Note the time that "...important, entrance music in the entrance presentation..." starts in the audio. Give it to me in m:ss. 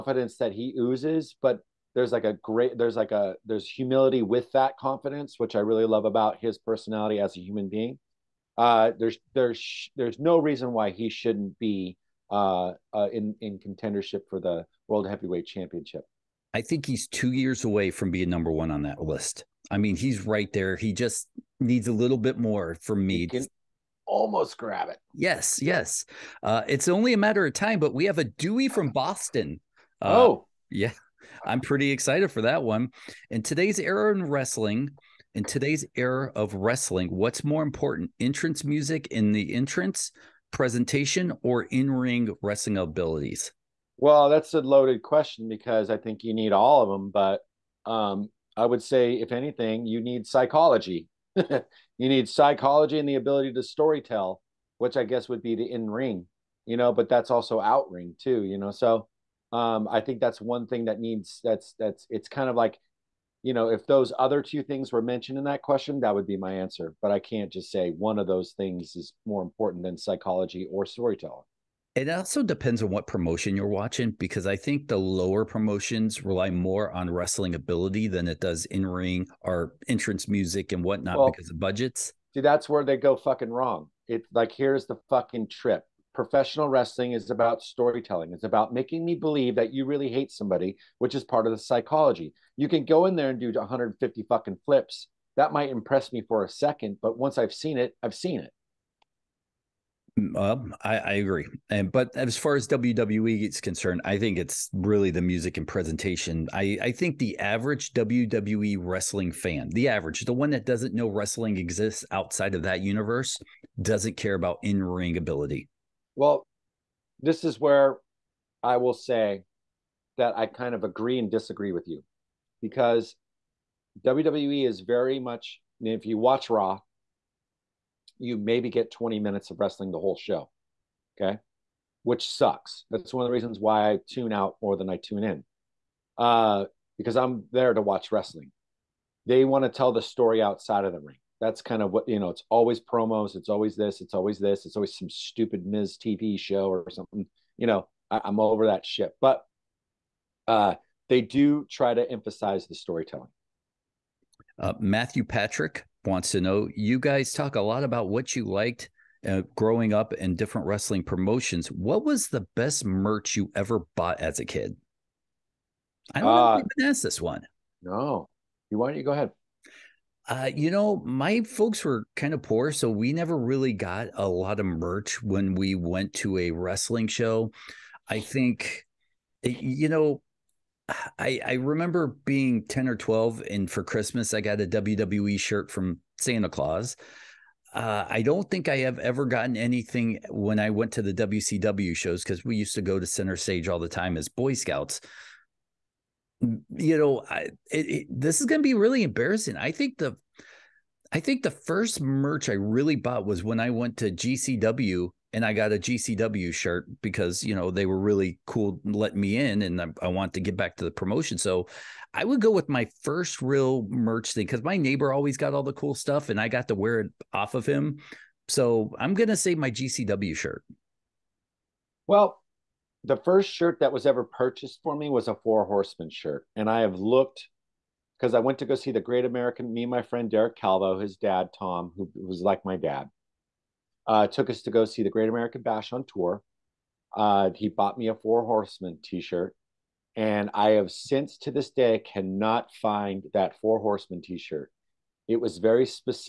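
0:37.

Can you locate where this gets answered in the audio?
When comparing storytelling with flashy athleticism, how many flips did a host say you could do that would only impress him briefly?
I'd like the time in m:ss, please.
1:33.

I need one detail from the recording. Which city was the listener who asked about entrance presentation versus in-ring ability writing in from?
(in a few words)
Boston.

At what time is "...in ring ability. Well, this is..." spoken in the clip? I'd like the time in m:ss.
1:54.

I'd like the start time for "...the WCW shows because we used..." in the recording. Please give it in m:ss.
3:11.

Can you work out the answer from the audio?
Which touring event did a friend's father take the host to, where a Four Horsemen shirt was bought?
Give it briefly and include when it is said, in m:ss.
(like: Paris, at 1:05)
The Great American Bash, at 3:55.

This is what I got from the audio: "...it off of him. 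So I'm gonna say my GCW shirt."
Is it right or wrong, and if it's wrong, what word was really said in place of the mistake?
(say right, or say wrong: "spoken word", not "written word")
right.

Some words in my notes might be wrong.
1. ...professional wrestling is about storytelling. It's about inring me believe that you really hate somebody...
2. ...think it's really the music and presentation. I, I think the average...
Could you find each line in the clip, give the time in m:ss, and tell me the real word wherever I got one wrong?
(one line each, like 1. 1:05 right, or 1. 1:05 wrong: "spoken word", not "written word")
1. 1:26 wrong: "making", not "inring"
2. 1:44 right.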